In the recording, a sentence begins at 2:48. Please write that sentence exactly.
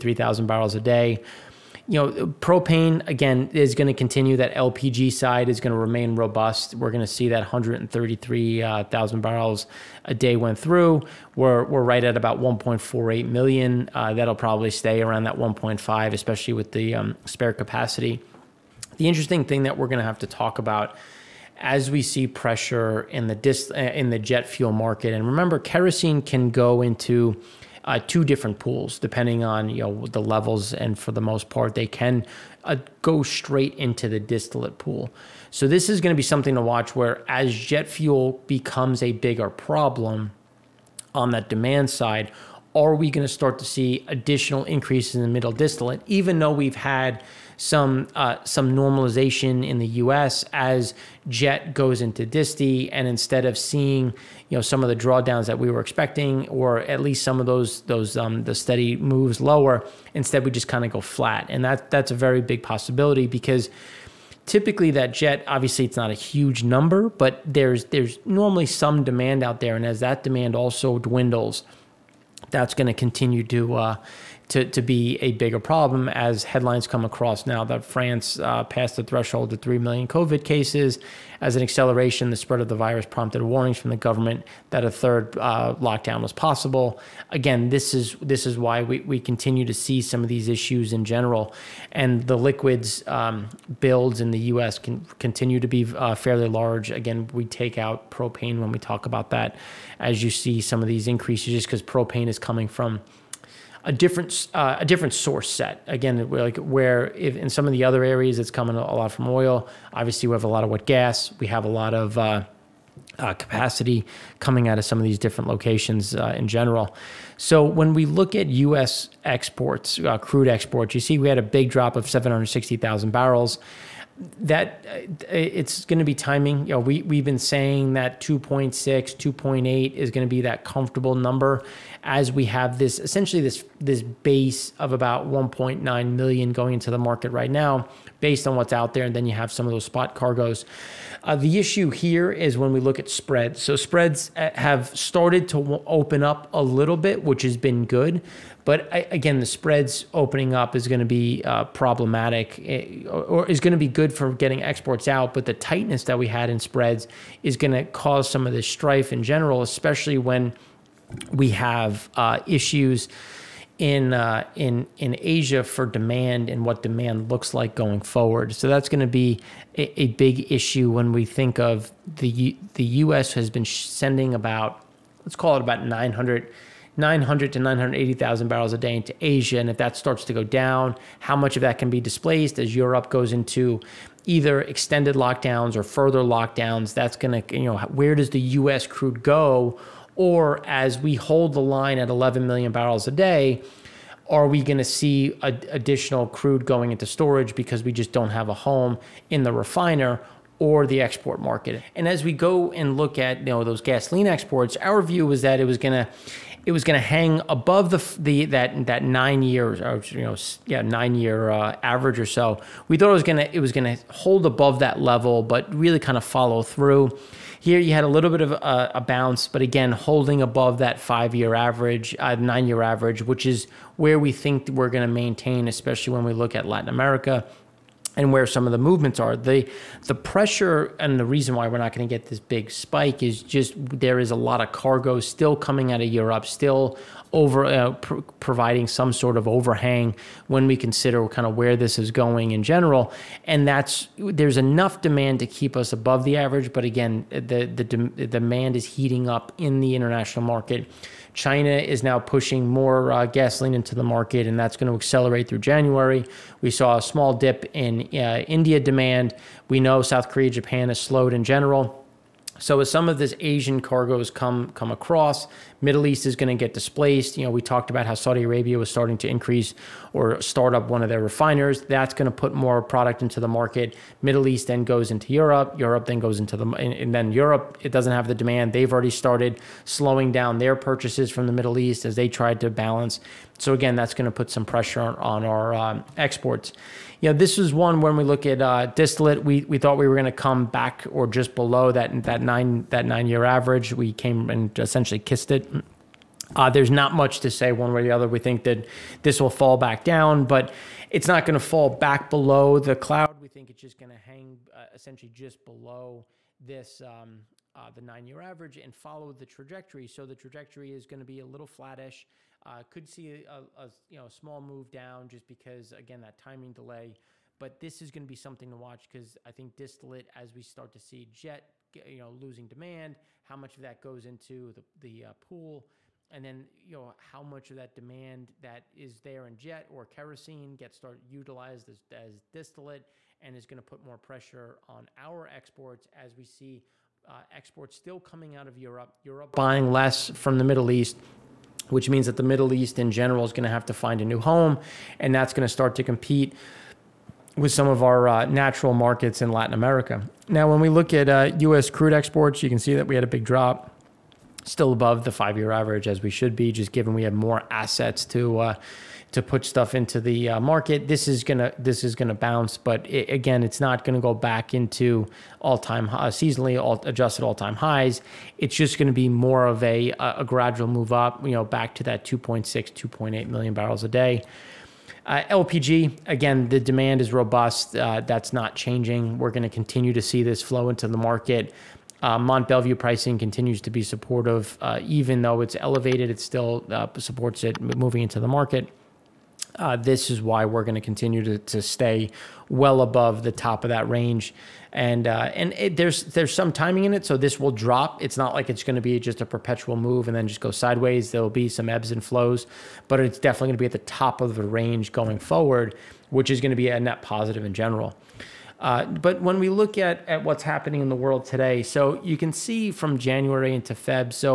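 So that's going to be a, a, big issue when we think of the the U.S.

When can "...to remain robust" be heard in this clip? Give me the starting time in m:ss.
0:05.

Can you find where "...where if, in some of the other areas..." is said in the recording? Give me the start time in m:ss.
1:46.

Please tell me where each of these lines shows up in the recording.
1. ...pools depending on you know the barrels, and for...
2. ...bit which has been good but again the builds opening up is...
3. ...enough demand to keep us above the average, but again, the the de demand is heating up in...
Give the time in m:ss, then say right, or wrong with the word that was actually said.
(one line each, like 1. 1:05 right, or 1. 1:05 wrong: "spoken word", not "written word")
1. 0:28 wrong: "levels", not "barrels"
2. 2:26 wrong: "spreads", not "builds"
3. 4:04 right.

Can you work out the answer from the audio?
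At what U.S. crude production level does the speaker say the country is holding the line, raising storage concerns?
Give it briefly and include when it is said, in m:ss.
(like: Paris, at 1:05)
11 million barrels a day, at 3:12.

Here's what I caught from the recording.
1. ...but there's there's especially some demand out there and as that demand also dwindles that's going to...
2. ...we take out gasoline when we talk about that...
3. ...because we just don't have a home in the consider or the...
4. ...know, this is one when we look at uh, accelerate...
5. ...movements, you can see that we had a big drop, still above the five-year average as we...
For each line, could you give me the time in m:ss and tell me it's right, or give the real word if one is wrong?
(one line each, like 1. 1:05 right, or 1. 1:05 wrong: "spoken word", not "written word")
1. 1:07 wrong: "normally", not "especially"
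2. 1:37 wrong: "propane", not "gasoline"
3. 3:17 wrong: "refiner", not "consider"
4. 4:47 wrong: "distillate", not "accelerate"
5. 5:52 wrong: "exports", not "movements".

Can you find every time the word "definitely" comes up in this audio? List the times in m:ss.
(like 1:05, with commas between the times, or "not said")
6:43.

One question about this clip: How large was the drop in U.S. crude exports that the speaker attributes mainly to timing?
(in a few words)
760,000 barrels.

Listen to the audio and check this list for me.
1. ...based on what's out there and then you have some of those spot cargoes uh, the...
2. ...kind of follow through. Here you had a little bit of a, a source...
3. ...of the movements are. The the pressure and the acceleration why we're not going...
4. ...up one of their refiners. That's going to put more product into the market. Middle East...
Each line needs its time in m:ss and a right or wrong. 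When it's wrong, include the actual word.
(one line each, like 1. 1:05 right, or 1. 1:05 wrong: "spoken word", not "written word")
1. 2:18 right
2. 3:35 wrong: "bounce", not "source"
3. 3:48 wrong: "reason", not "acceleration"
4. 4:30 right.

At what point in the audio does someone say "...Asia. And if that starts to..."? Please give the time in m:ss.
2:59.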